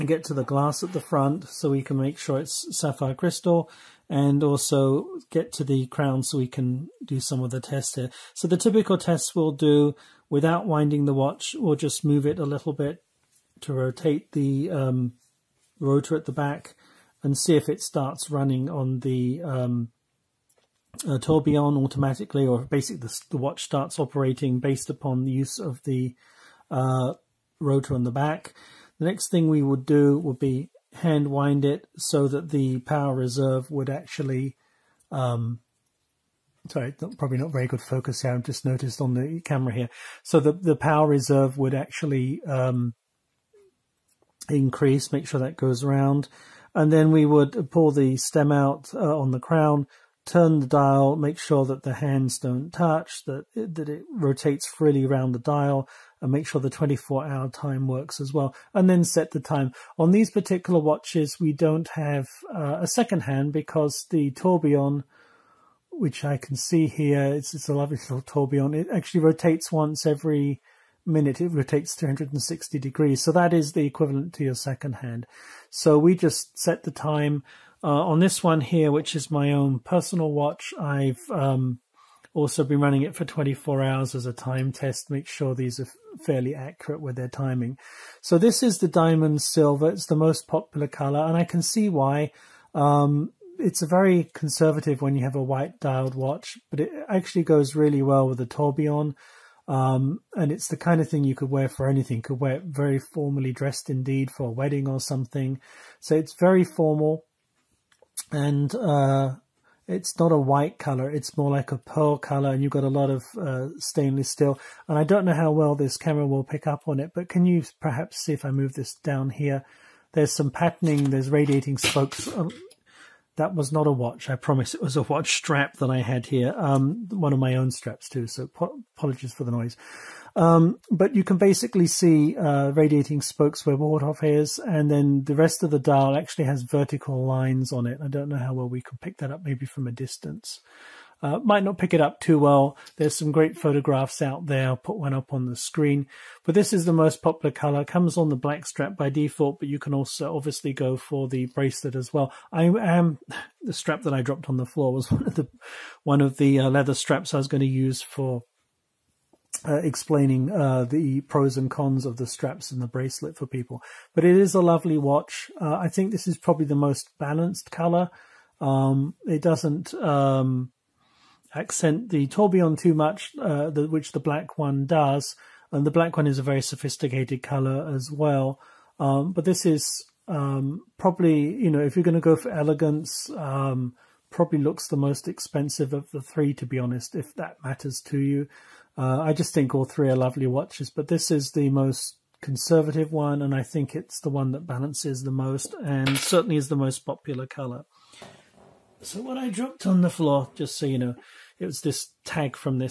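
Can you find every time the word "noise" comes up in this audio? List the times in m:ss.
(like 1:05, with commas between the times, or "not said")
2:09.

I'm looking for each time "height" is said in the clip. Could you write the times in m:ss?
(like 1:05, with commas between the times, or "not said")
not said.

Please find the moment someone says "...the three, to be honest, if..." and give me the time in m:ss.
3:06.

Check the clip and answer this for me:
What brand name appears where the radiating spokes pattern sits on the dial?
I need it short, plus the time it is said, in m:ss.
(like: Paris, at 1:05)
Waldhoff, at 2:13.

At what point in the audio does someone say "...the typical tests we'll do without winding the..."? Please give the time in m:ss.
0:08.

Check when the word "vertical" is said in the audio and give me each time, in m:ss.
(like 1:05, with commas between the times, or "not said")
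2:16.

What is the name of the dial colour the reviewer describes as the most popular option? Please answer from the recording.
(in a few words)
Diamond silver.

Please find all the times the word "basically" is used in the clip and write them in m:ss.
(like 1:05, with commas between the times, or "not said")
0:22, 2:11.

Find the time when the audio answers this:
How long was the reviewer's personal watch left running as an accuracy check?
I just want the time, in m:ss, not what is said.
1:23.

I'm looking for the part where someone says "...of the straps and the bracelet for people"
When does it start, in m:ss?
2:42.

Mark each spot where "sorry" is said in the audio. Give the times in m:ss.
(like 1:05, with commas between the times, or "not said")
0:36.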